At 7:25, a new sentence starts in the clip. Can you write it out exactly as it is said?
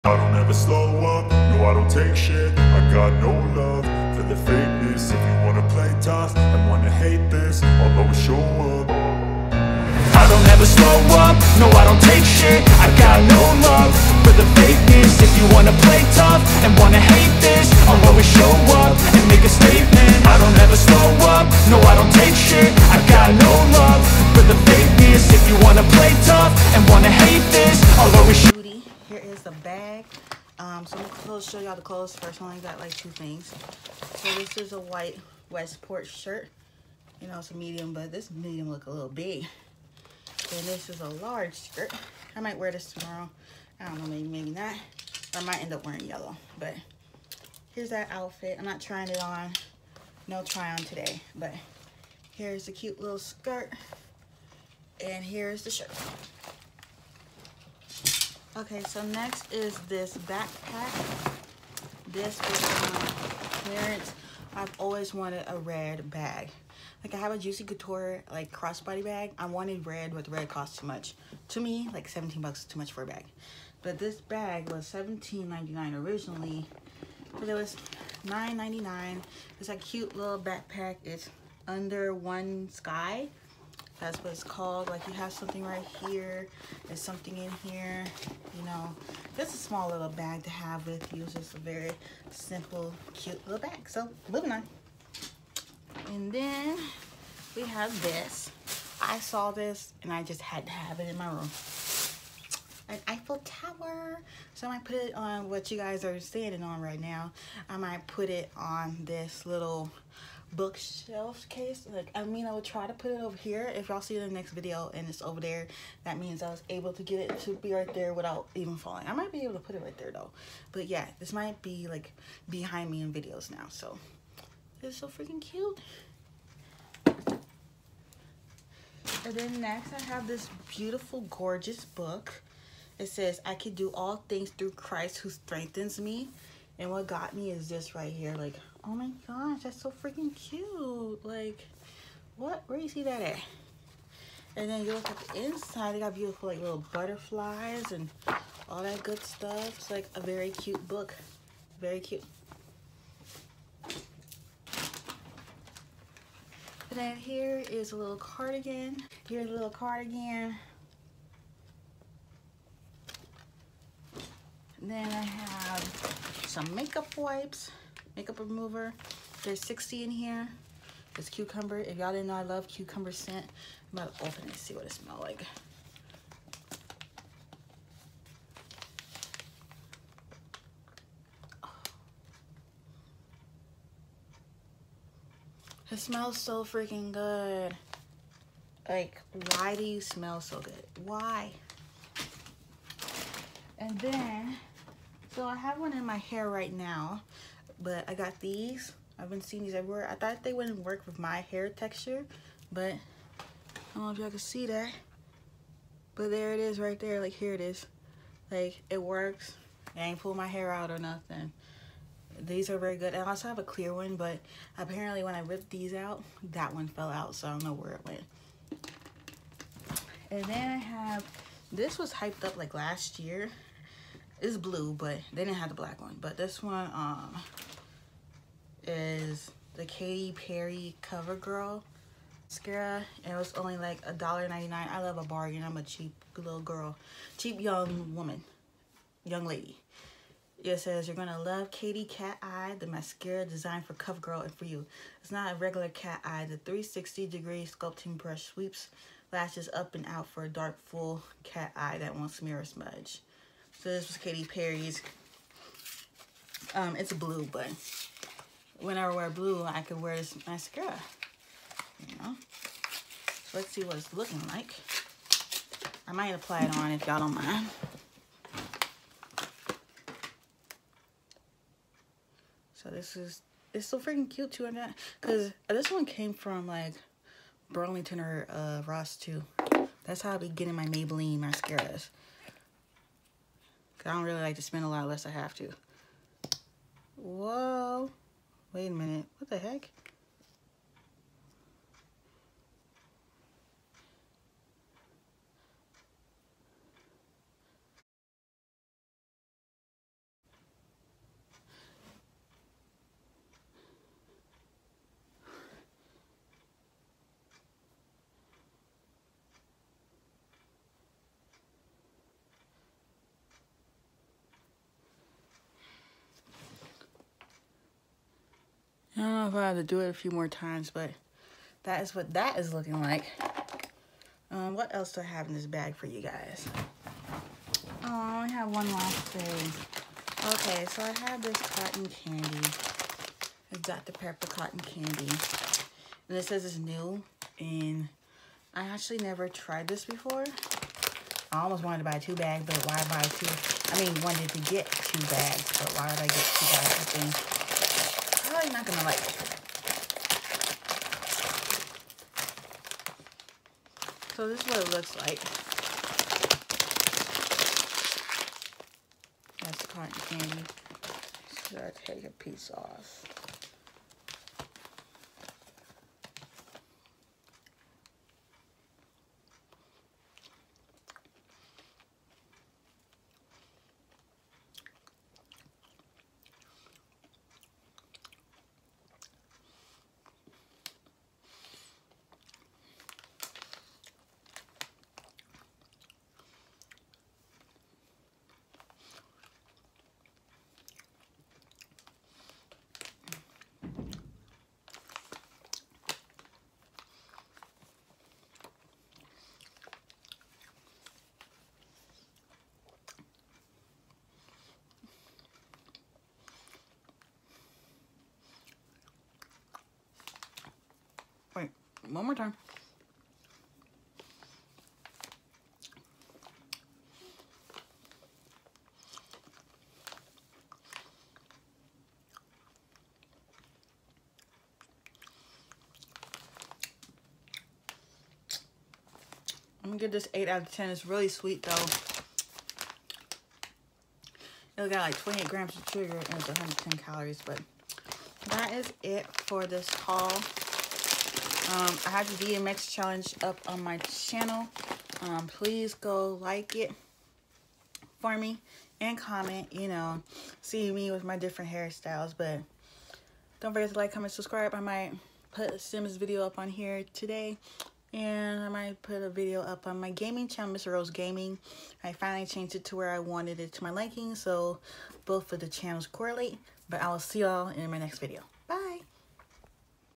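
Um, please go like it for me and comment, you know, see me with my different hairstyles.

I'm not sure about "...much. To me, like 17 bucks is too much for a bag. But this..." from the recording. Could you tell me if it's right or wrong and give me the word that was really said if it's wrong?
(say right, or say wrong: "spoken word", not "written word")
right.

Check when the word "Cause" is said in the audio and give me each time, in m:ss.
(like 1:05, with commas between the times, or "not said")
4:35, 4:43.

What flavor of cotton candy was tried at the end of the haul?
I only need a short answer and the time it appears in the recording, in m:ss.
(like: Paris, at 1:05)
Dr. Pepper, at 5:33.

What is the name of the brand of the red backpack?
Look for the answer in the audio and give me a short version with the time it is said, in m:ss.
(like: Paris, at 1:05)
Under One Sky, at 1:21.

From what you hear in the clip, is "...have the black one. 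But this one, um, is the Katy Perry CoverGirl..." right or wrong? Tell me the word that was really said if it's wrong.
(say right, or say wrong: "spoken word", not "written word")
right.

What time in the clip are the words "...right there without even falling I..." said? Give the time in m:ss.
1:57.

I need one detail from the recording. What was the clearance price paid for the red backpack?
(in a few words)
$9.99.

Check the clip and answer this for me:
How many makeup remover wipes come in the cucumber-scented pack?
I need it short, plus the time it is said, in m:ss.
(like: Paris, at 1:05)
60, at 2:49.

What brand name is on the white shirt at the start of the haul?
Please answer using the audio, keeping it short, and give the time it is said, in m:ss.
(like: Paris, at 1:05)
Westport, at 0:35.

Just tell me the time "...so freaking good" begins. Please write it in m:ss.
3:06.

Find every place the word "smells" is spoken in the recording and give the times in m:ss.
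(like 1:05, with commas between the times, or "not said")
2:54, 3:05, 3:09.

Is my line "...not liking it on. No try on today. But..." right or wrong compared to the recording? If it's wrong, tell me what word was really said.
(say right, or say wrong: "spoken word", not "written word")
wrong: "trying", not "liking".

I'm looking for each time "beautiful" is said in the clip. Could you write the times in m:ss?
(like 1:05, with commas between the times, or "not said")
2:10, 2:26.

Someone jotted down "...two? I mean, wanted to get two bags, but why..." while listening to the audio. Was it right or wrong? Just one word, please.
right.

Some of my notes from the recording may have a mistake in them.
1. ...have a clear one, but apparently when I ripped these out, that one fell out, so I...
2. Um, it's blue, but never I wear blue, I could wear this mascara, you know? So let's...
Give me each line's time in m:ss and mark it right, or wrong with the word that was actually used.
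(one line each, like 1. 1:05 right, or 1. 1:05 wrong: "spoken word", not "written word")
1. 3:33 right
2. 4:16 wrong: "whenever", not "never".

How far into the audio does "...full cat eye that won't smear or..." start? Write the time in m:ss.
4:10.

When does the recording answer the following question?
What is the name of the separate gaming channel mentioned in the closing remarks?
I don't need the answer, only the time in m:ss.
7:40.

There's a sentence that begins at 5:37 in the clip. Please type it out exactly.
And I actually never tried this before.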